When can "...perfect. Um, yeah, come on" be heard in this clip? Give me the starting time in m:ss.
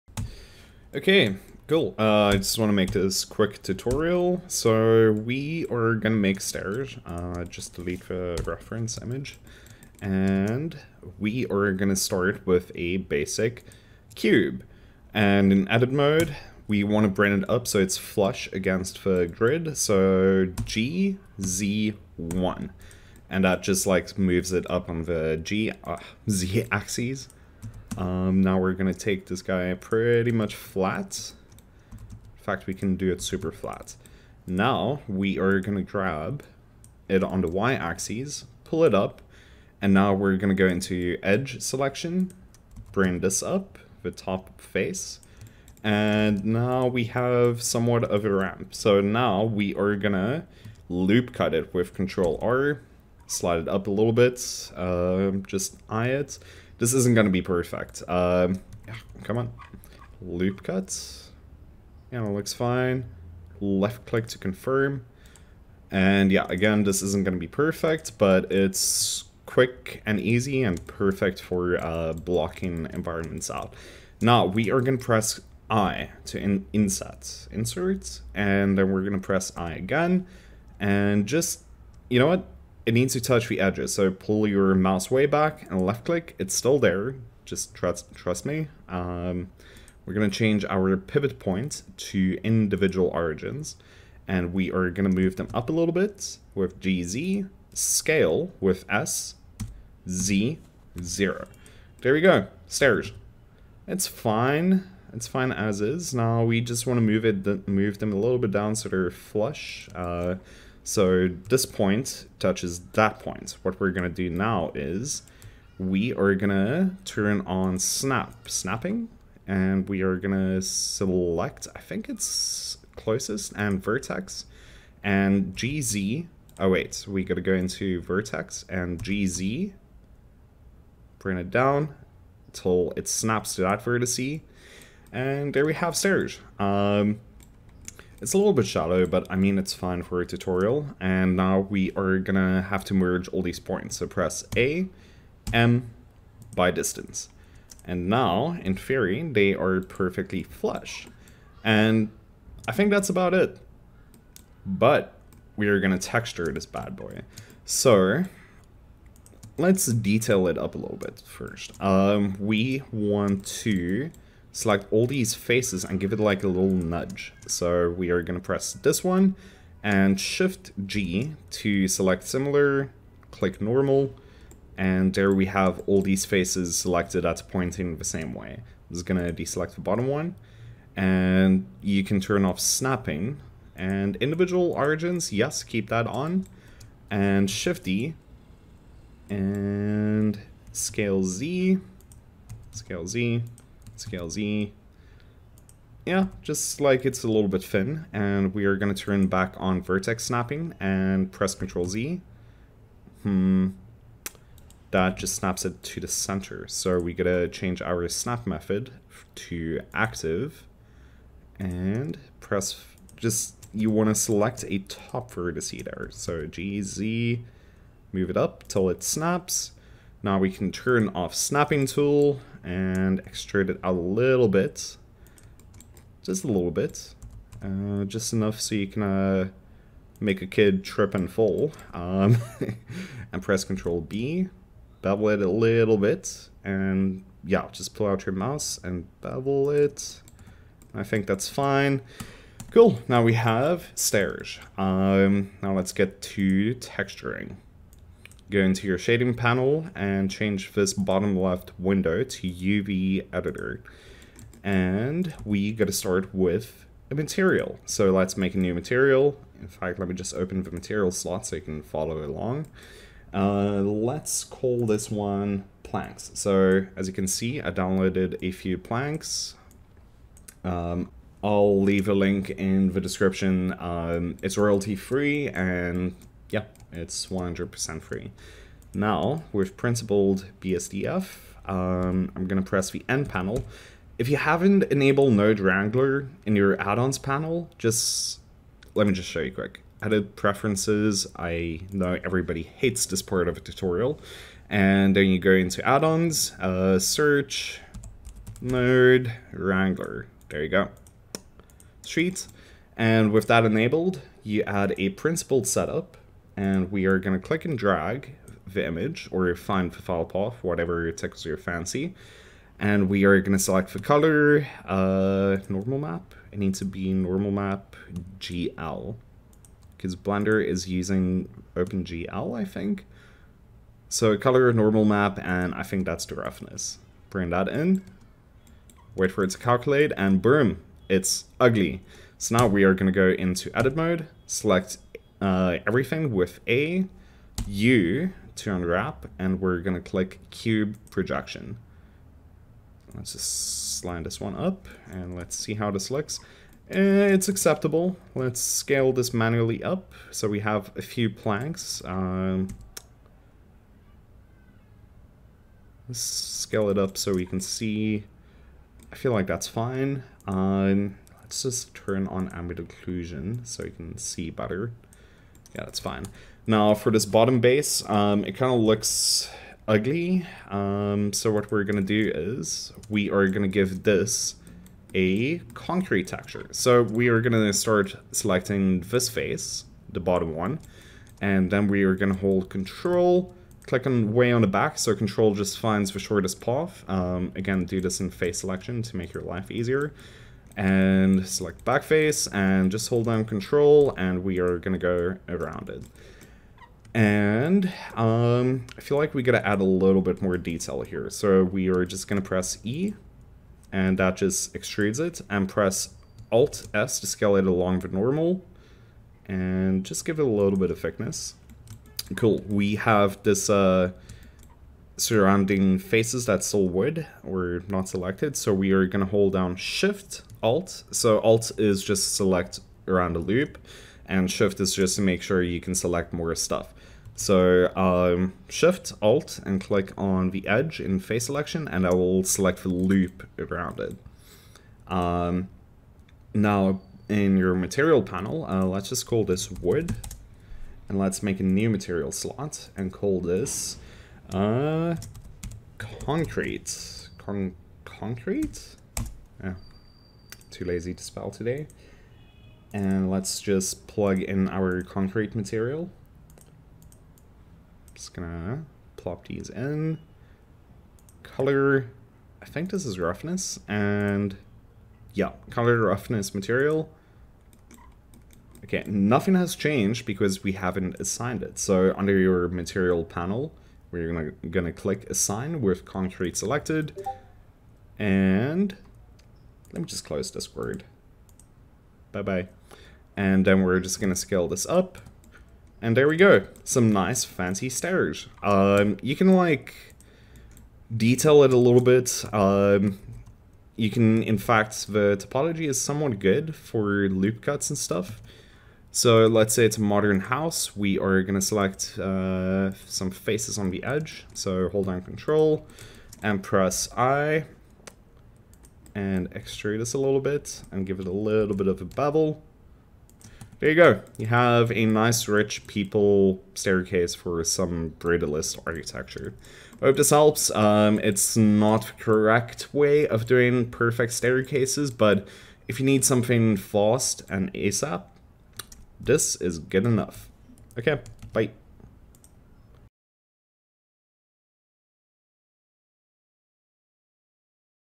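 0:57.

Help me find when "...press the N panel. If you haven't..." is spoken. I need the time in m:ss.
4:42.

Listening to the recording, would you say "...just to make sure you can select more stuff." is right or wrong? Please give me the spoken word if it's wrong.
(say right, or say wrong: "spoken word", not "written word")
right.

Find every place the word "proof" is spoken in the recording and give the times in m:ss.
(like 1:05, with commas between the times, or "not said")
not said.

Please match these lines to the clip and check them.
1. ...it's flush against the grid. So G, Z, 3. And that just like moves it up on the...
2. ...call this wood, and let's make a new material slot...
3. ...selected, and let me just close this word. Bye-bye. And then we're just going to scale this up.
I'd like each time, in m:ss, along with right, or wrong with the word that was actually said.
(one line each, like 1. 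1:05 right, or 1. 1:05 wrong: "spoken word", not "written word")
1. 0:17 wrong: "1", not "3"
2. 7:19 right
3. 7:56 right.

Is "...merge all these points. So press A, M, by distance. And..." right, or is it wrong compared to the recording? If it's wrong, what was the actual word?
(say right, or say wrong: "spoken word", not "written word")
right.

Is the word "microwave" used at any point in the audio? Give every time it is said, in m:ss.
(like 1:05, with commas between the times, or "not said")
not said.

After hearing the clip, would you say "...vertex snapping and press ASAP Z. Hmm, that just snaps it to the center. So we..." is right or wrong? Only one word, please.
wrong.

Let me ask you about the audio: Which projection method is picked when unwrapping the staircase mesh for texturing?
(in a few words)
Cube projection.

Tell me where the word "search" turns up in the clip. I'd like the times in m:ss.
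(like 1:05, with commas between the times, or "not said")
4:56.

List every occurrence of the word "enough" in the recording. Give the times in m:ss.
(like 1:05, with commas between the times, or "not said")
3:48, 8:50.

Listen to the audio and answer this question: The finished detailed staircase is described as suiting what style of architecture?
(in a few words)
Brutalist.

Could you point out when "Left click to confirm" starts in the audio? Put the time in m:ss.
1:03.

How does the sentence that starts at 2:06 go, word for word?
Oh wait, we gotta go into vertex and GZ, Bring it down till it snaps to that vertex.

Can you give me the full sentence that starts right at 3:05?
Yes, keep that on and shift D and scale Z, scale Z, scale Z.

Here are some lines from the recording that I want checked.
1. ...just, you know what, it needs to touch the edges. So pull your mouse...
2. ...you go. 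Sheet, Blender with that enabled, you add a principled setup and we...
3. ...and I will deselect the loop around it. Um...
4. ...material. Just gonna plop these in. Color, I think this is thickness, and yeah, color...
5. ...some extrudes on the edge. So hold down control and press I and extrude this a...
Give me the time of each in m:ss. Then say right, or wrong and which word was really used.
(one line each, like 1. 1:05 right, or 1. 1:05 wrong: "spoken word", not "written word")
1. 1:21 right
2. 5:00 wrong: "And", not "Blender"
3. 7:11 wrong: "select", not "deselect"
4. 7:35 wrong: "roughness", not "thickness"
5. 8:23 wrong: "faces", not "extrudes".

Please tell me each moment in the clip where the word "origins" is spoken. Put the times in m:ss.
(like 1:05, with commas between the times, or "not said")
1:33, 3:04.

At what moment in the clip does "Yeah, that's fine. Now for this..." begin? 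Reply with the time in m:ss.
6:05.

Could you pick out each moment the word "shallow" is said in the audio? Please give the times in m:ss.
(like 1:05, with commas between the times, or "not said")
2:18.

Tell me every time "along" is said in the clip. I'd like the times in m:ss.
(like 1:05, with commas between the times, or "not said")
4:22, 6:47.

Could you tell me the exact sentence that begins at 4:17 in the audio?
So let's make a new material.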